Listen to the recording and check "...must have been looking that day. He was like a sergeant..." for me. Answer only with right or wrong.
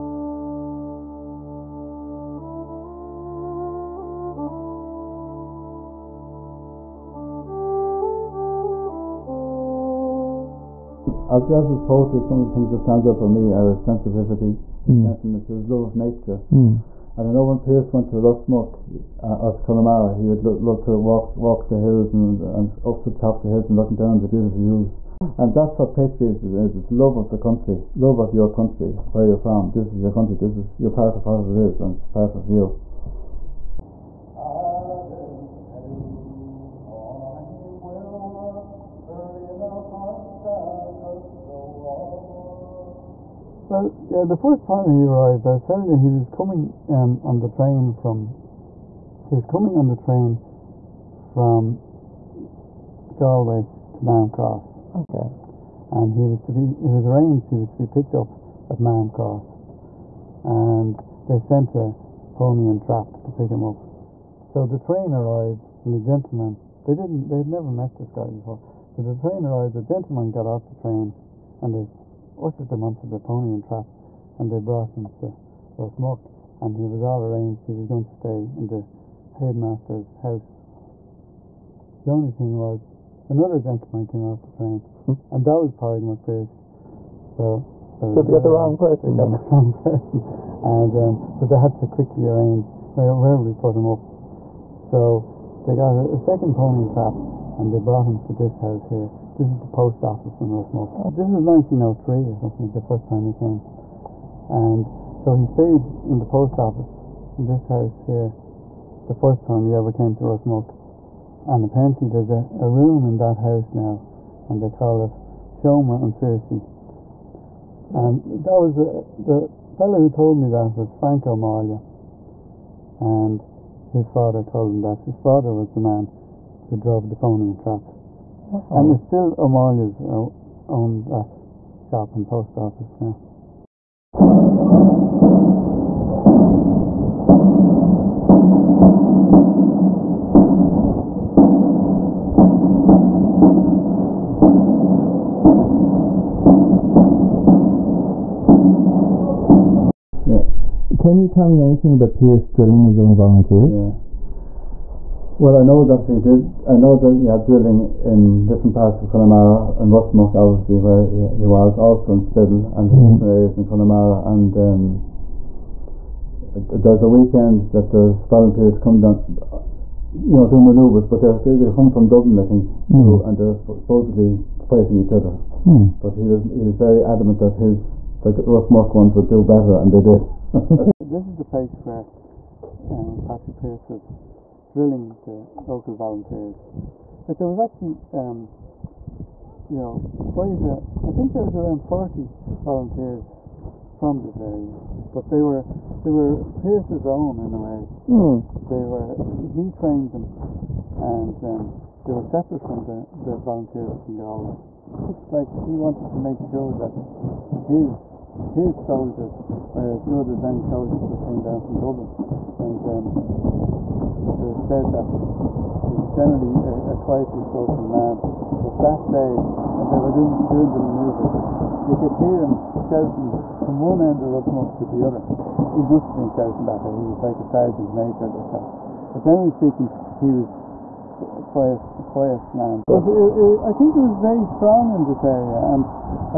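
wrong.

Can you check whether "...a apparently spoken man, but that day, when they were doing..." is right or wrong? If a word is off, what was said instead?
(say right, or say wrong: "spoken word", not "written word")
wrong: "quietly", not "apparently".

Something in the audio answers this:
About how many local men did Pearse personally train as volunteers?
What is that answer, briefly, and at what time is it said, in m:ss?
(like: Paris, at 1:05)
40, at 3:11.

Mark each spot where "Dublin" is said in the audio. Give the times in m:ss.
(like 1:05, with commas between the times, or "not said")
2:52, 3:31.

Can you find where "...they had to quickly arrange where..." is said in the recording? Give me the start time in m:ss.
1:31.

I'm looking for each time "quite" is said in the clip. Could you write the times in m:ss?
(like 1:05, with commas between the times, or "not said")
3:10.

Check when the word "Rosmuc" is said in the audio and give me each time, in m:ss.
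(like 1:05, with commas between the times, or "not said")
0:18, 1:15, 1:40, 1:50, 2:39, 2:58, 3:44.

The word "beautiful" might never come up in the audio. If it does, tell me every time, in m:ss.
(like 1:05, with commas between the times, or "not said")
0:24.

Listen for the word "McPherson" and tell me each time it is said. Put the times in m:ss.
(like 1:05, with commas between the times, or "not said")
1:26.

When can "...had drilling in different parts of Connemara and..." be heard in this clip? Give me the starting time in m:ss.
2:37.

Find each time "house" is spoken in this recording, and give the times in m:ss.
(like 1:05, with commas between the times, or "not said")
1:20, 1:38, 1:47, 1:53.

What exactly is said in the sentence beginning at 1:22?
The only thing was, another gentleman came out the train, hmm.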